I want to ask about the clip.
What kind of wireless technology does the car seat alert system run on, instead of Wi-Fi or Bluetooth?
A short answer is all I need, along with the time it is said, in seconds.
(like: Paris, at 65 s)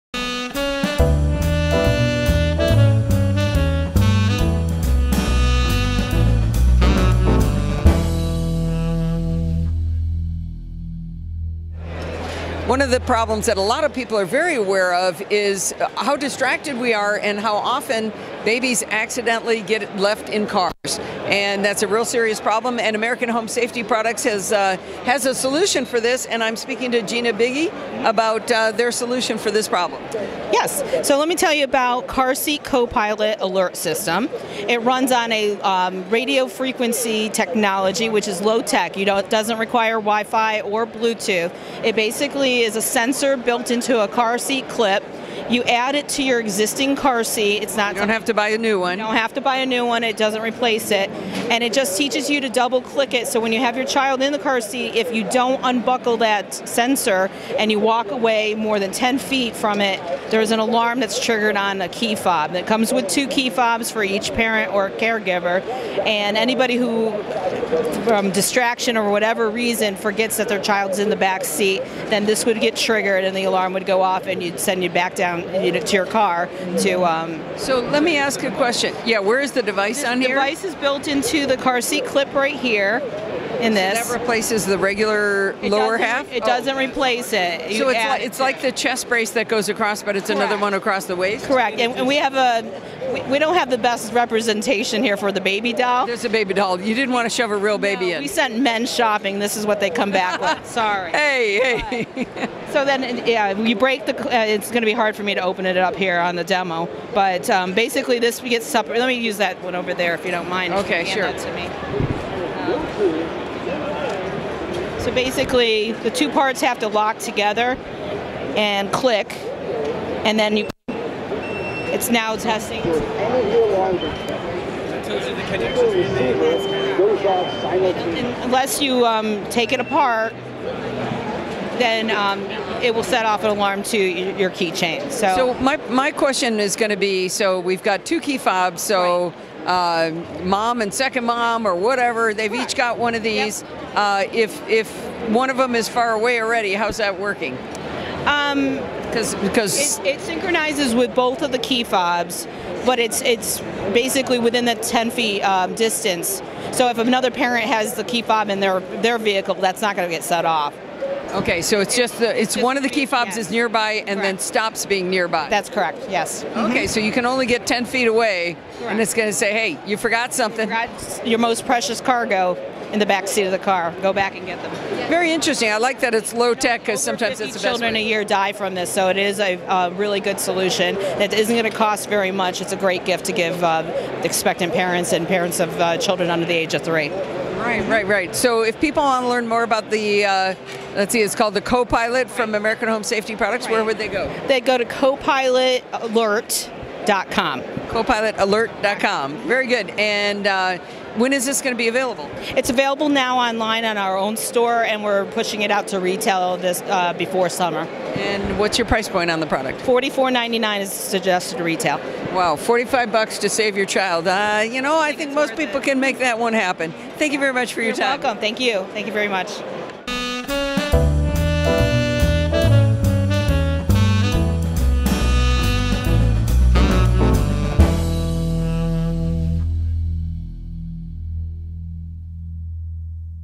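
radio frequency, at 36 s.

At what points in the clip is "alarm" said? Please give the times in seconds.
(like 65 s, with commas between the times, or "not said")
60 s, 73 s, 133 s.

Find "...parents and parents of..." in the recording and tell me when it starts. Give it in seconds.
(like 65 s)
184 s.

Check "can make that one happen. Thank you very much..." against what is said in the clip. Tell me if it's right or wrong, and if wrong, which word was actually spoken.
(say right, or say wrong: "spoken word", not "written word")
right.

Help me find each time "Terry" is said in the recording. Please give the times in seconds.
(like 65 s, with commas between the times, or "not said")
not said.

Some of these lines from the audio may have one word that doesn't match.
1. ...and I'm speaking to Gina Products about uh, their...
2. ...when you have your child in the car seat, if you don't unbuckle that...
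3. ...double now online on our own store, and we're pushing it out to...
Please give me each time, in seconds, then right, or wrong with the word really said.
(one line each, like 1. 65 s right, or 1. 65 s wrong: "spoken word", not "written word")
1. 26 s wrong: "Bigge", not "Products"
2. 53 s right
3. 202 s wrong: "available", not "double".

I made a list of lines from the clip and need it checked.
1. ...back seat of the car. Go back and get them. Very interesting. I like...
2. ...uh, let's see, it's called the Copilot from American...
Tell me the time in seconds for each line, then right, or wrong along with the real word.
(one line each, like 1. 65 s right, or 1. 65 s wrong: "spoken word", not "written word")
1. 173 s right
2. 190 s right.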